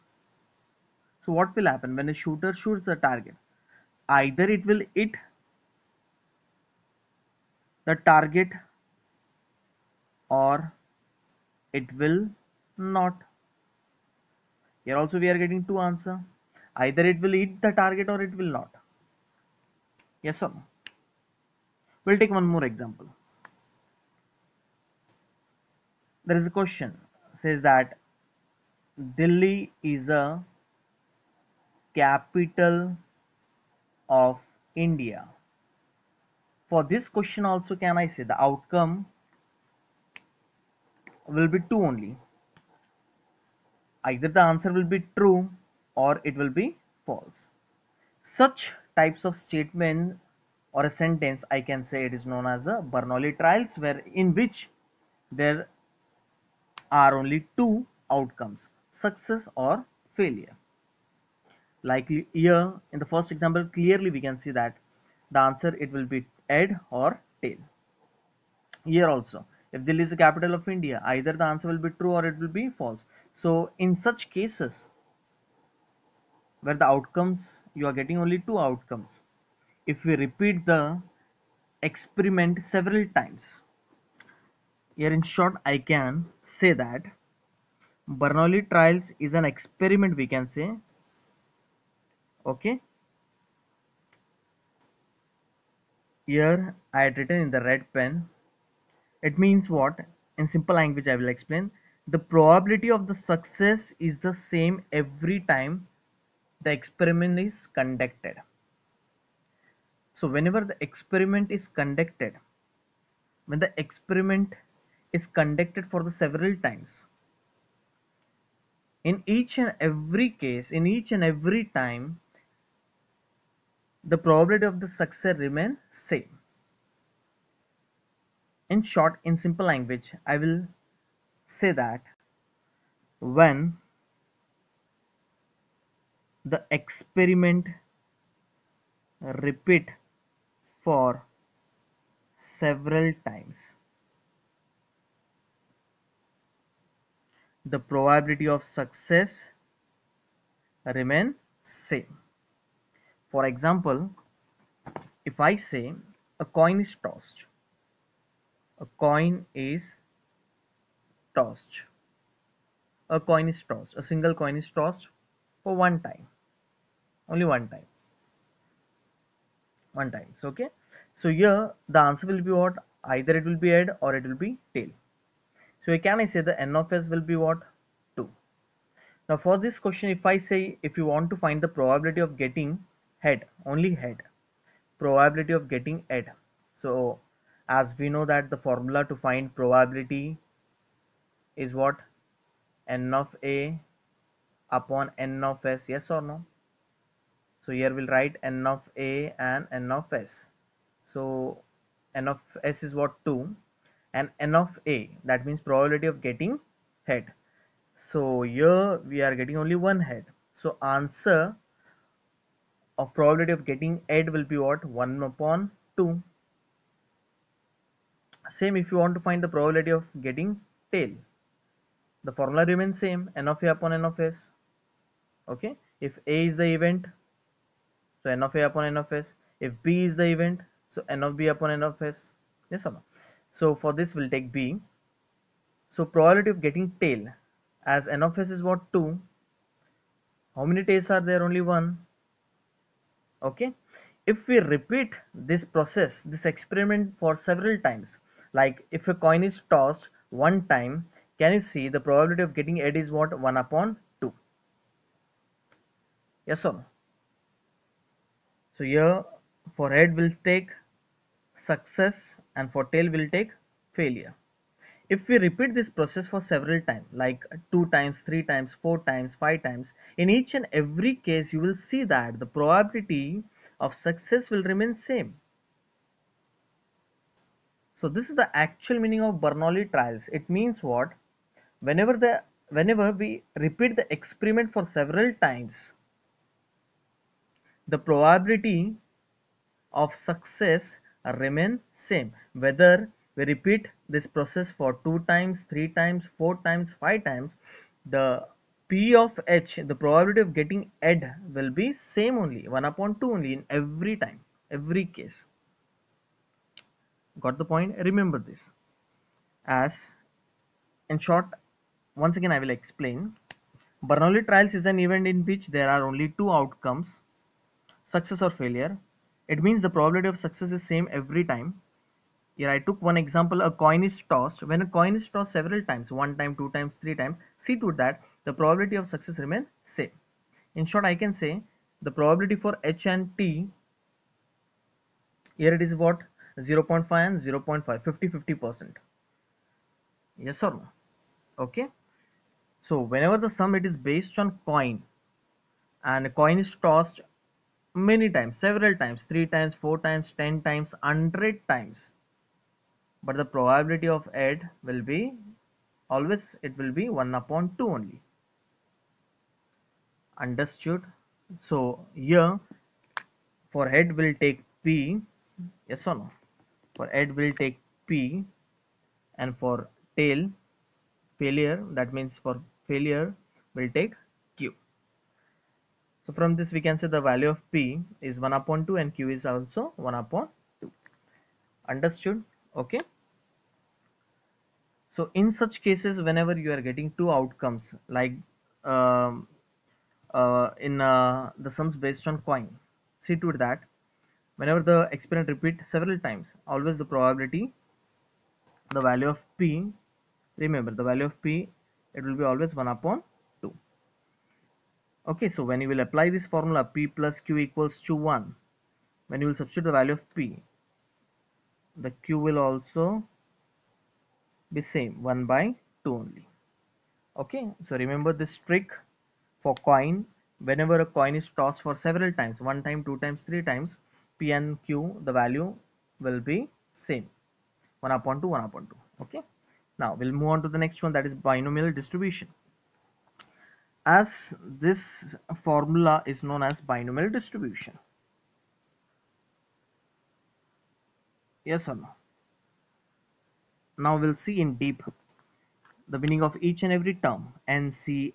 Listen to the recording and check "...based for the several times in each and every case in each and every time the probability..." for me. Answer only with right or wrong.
wrong.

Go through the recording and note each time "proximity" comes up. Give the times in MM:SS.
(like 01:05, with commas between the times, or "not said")
not said.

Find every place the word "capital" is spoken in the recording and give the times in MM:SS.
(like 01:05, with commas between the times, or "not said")
00:31, 01:10.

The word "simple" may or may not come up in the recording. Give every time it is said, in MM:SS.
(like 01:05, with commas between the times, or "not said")
01:40, 02:09.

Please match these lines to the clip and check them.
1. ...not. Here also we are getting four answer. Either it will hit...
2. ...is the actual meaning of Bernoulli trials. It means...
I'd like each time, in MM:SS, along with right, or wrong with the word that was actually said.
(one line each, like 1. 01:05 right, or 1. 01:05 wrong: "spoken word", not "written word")
1. 00:12 wrong: "two", not "four"
2. 04:38 right.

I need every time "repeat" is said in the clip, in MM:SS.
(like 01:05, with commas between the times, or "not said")
01:20, 02:19, 04:04, 04:25, 04:43, 04:53, 06:35.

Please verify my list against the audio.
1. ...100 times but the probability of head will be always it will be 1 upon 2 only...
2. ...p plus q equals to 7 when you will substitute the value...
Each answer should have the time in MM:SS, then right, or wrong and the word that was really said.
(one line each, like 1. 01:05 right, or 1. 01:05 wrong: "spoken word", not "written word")
1. 05:51 right
2. 06:46 wrong: "1", not "7".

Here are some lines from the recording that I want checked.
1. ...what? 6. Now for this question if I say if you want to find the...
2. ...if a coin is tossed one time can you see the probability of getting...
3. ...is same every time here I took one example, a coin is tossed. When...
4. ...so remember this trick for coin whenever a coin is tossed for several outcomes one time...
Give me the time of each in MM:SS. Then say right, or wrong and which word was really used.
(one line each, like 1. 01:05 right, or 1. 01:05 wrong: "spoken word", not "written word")
1. 02:57 wrong: "2", not "6"
2. 04:08 right
3. 05:20 right
4. 06:57 wrong: "times", not "outcomes".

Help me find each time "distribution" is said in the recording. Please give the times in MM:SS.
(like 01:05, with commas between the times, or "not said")
07:11, 07:17.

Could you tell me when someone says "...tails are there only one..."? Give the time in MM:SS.
04:00.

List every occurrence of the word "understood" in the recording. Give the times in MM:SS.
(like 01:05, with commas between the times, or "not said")
06:00, 06:21.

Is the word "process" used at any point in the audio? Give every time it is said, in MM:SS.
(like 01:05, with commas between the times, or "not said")
04:05, 04:25, 04:54.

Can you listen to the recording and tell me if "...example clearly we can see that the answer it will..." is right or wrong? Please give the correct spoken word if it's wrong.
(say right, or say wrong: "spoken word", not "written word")
right.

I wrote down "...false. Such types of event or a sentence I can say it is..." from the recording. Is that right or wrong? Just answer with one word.
wrong.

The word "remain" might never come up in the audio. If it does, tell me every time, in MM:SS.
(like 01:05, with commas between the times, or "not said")
02:05, 02:30, 03:42, 04:34, 04:51, 05:29.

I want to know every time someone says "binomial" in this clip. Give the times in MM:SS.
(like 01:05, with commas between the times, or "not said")
07:11, 07:16.